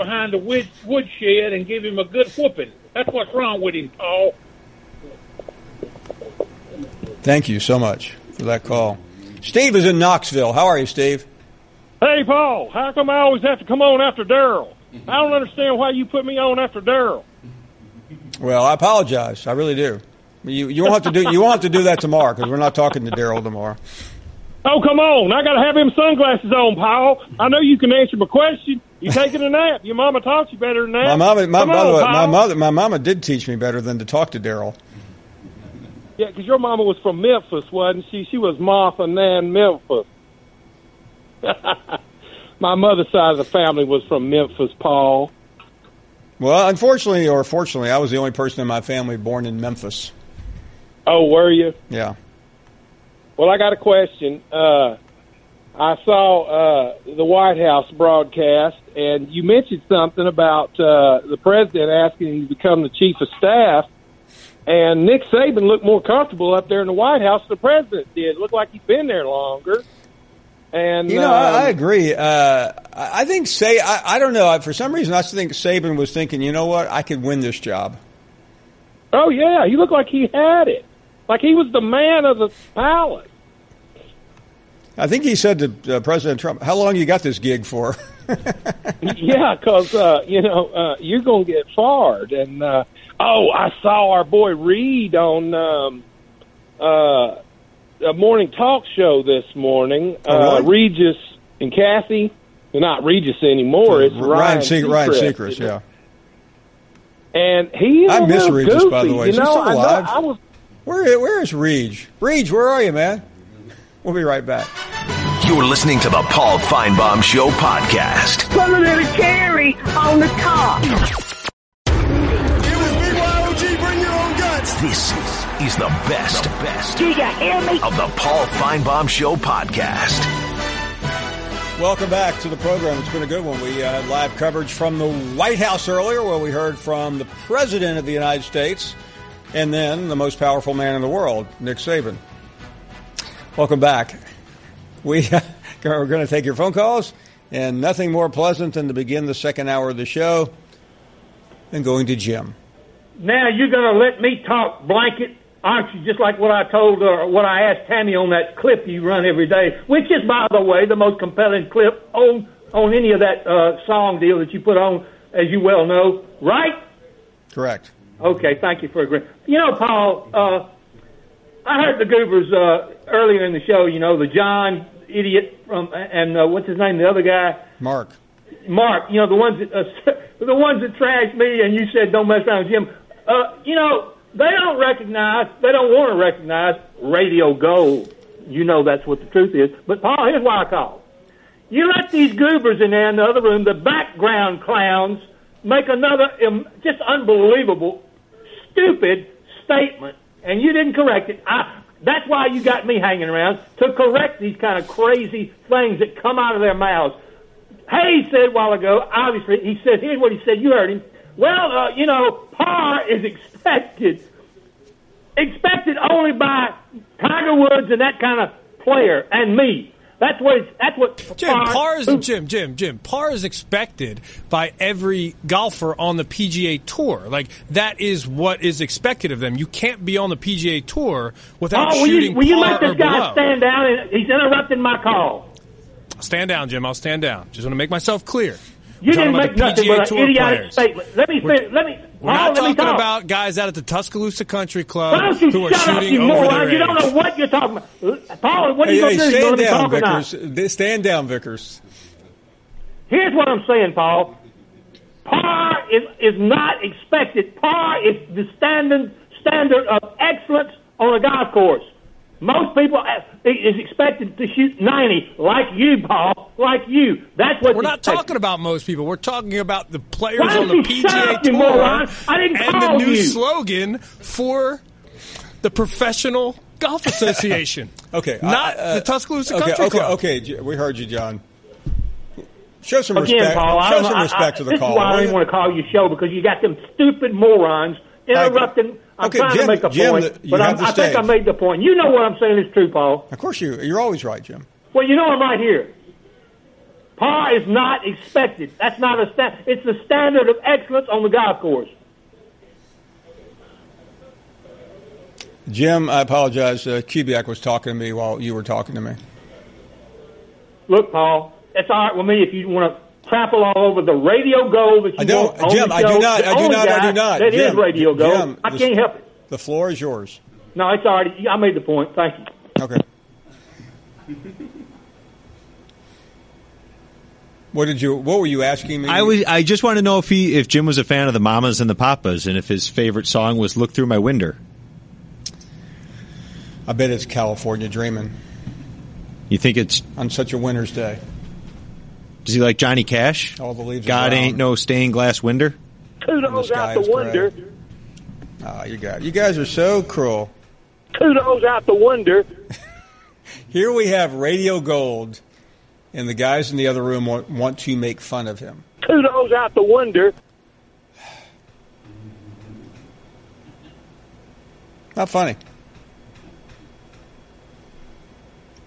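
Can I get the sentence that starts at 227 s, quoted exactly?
Like that is what is expected of them.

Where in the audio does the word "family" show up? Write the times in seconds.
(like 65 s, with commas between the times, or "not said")
43 s, 48 s.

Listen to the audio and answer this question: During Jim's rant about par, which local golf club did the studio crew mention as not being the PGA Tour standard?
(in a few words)
Tuscaloosa Country Club.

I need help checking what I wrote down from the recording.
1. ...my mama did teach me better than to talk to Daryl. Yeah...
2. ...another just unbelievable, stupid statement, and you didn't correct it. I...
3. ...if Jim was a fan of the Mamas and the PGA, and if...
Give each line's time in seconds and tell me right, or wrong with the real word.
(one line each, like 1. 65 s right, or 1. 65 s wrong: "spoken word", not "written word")
1. 32 s right
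2. 195 s right
3. 330 s wrong: "Papas", not "PGA".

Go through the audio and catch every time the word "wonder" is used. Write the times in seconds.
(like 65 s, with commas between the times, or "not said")
347 s, 351 s, 359 s.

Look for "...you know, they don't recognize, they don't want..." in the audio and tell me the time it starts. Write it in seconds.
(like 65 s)
183 s.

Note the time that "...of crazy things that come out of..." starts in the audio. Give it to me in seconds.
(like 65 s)
204 s.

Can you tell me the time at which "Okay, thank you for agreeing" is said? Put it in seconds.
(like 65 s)
168 s.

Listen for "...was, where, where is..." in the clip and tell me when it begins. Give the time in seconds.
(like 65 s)
110 s.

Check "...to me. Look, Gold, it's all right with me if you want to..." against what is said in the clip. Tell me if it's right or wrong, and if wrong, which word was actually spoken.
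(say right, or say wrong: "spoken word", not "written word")
wrong: "Paul", not "Gold".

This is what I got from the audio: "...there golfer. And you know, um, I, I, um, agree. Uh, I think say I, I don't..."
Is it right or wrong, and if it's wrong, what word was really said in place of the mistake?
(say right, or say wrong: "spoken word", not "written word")
wrong: "longer", not "golfer".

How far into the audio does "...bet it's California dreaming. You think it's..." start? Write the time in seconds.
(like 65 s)
336 s.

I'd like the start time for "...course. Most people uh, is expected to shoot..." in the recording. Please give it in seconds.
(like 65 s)
261 s.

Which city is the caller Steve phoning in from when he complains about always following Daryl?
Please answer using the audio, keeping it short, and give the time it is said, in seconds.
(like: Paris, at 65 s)
Knoxville, at 9 s.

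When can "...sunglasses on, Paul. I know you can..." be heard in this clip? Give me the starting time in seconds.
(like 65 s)
25 s.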